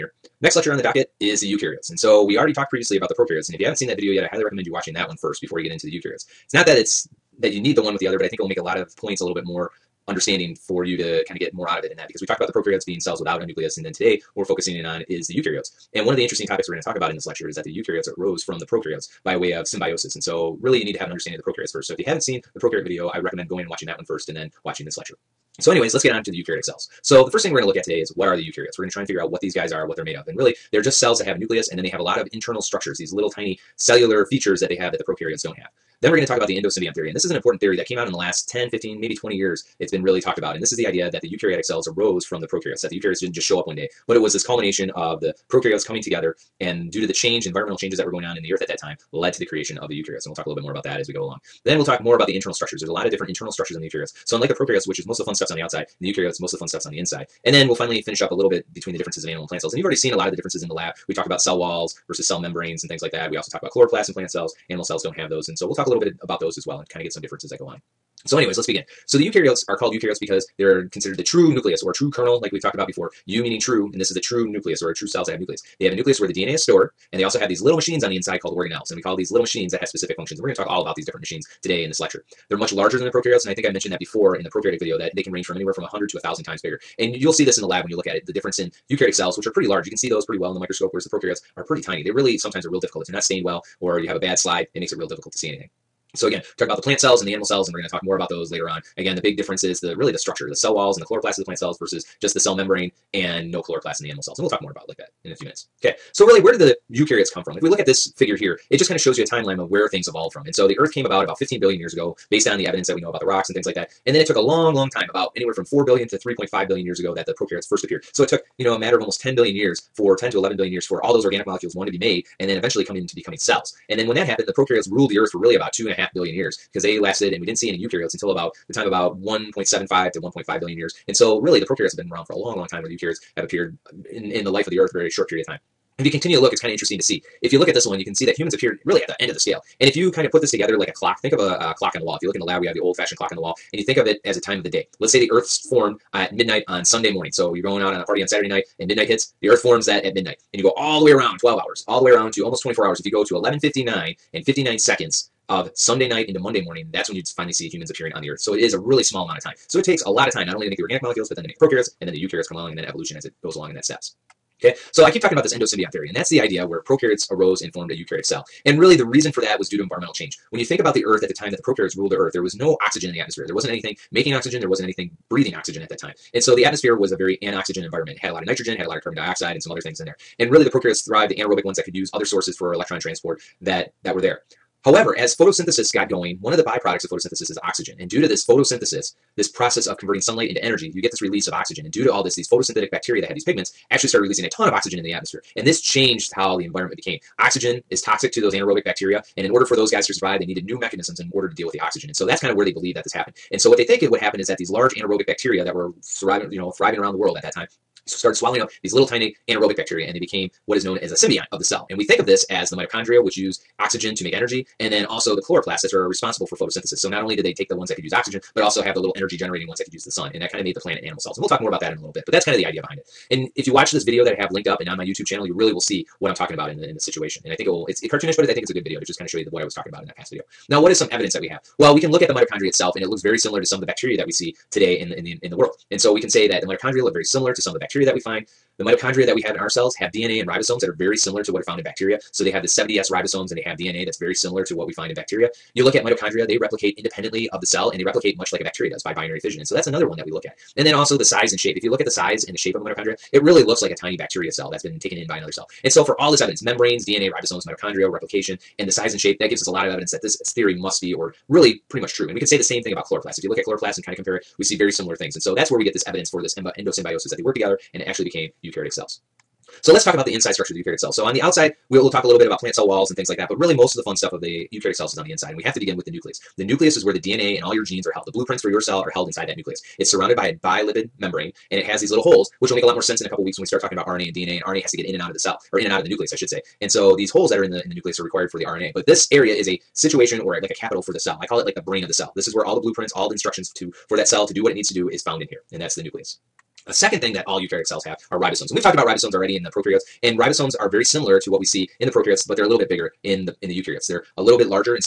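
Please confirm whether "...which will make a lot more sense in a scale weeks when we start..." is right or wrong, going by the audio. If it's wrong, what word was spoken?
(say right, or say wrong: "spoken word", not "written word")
wrong: "couple", not "scale".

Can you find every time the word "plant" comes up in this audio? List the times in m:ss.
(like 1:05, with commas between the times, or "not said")
0:59, 1:04, 1:36, 1:41, 3:40, 4:32.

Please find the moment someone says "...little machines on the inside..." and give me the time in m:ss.
1:17.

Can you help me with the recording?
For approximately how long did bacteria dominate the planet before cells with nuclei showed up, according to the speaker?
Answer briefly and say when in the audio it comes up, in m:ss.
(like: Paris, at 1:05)
two and a half billion years, at 2:05.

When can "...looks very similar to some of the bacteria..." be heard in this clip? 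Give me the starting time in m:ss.
3:53.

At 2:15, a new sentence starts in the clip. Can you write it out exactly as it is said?
If you continue to look, it's kind of interesting to see.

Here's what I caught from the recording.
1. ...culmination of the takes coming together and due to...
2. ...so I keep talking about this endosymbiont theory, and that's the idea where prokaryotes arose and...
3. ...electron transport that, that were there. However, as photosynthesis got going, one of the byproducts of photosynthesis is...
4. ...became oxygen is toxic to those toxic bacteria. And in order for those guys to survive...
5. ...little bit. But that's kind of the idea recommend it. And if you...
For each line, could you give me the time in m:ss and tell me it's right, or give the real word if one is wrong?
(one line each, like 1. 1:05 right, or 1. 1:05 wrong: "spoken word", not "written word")
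1. 0:44 wrong: "prokaryotes", not "takes"
2. 2:44 right
3. 3:02 right
4. 3:16 wrong: "anaerobic", not "toxic"
5. 3:42 wrong: "behind", not "recommend".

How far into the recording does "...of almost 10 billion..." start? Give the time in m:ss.
1:58.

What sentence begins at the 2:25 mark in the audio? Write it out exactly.
Let's say the Earth's formed at midnight on Sunday morning.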